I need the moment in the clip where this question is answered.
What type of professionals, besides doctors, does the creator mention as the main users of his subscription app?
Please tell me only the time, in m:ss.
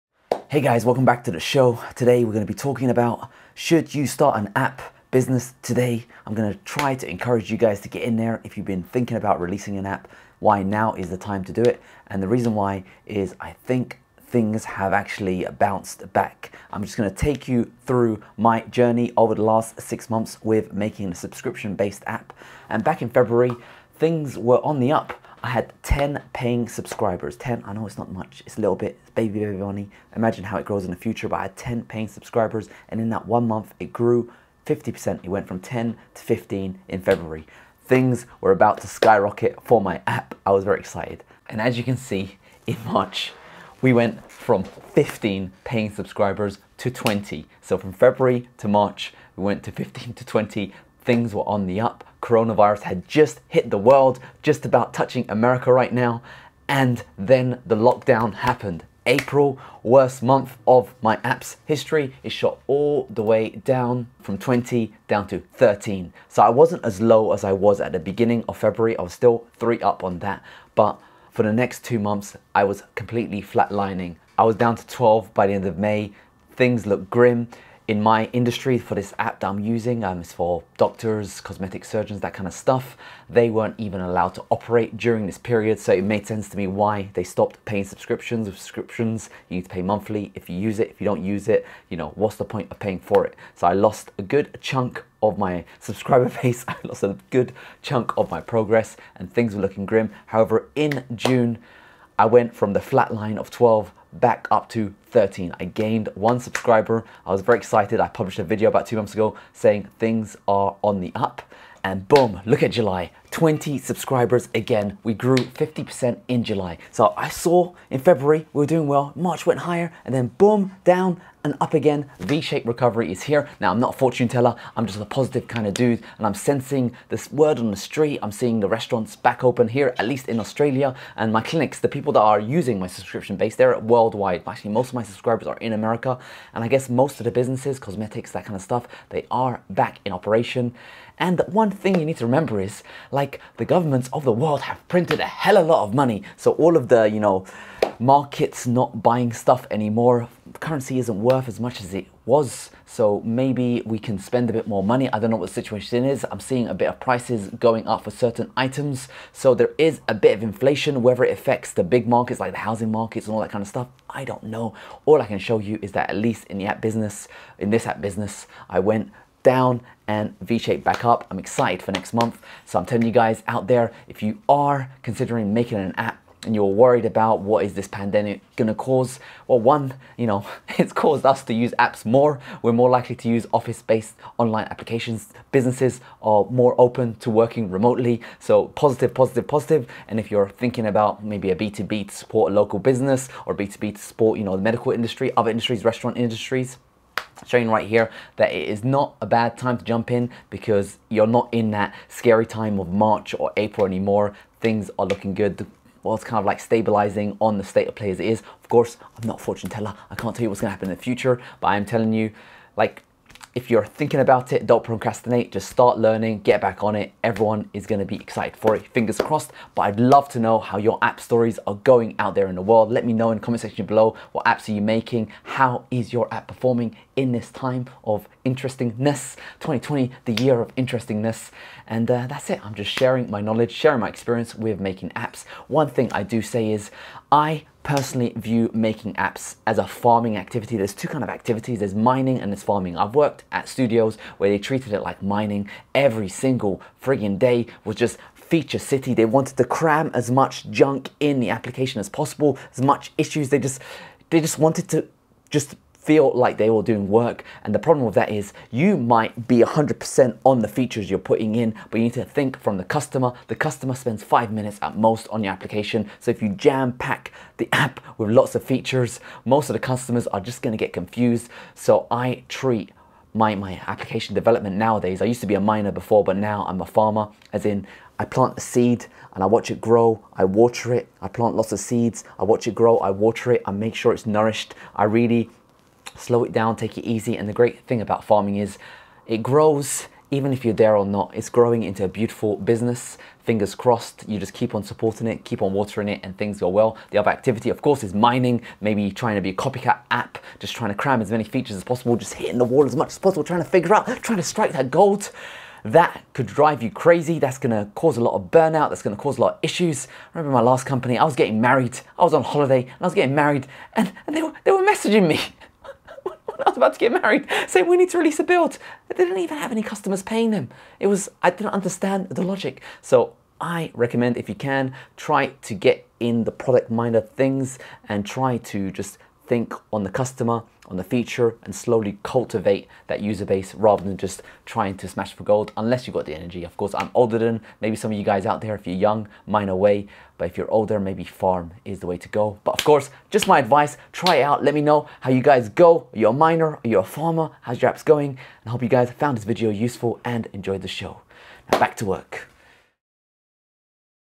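1:21.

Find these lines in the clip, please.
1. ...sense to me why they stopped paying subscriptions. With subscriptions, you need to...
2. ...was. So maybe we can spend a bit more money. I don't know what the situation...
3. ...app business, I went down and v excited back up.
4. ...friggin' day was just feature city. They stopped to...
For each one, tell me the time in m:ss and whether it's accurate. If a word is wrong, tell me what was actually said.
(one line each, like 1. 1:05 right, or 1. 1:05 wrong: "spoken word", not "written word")
1. 1:26 right
2. 2:32 right
3. 2:47 wrong: "shaped", not "excited"
4. 4:07 wrong: "wanted", not "stopped".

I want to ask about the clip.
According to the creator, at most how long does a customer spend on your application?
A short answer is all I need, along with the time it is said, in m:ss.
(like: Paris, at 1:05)
five minutes, at 4:24.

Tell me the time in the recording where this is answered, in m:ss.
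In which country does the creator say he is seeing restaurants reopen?
2:10.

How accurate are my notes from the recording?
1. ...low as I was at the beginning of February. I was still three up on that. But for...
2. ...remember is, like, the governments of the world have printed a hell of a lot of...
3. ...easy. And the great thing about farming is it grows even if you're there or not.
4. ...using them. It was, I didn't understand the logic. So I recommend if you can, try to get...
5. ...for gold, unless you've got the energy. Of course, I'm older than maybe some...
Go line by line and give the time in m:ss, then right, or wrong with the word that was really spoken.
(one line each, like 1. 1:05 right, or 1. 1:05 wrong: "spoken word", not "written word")
1. 1:07 right
2. 2:22 right
3. 4:47 right
4. 5:20 wrong: "paying", not "using"
5. 5:35 right.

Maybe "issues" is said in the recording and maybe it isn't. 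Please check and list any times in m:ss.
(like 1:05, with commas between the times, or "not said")
4:13, 5:09.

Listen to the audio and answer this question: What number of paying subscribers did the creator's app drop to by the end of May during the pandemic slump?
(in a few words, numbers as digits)
12.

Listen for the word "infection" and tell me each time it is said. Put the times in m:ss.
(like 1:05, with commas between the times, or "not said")
not said.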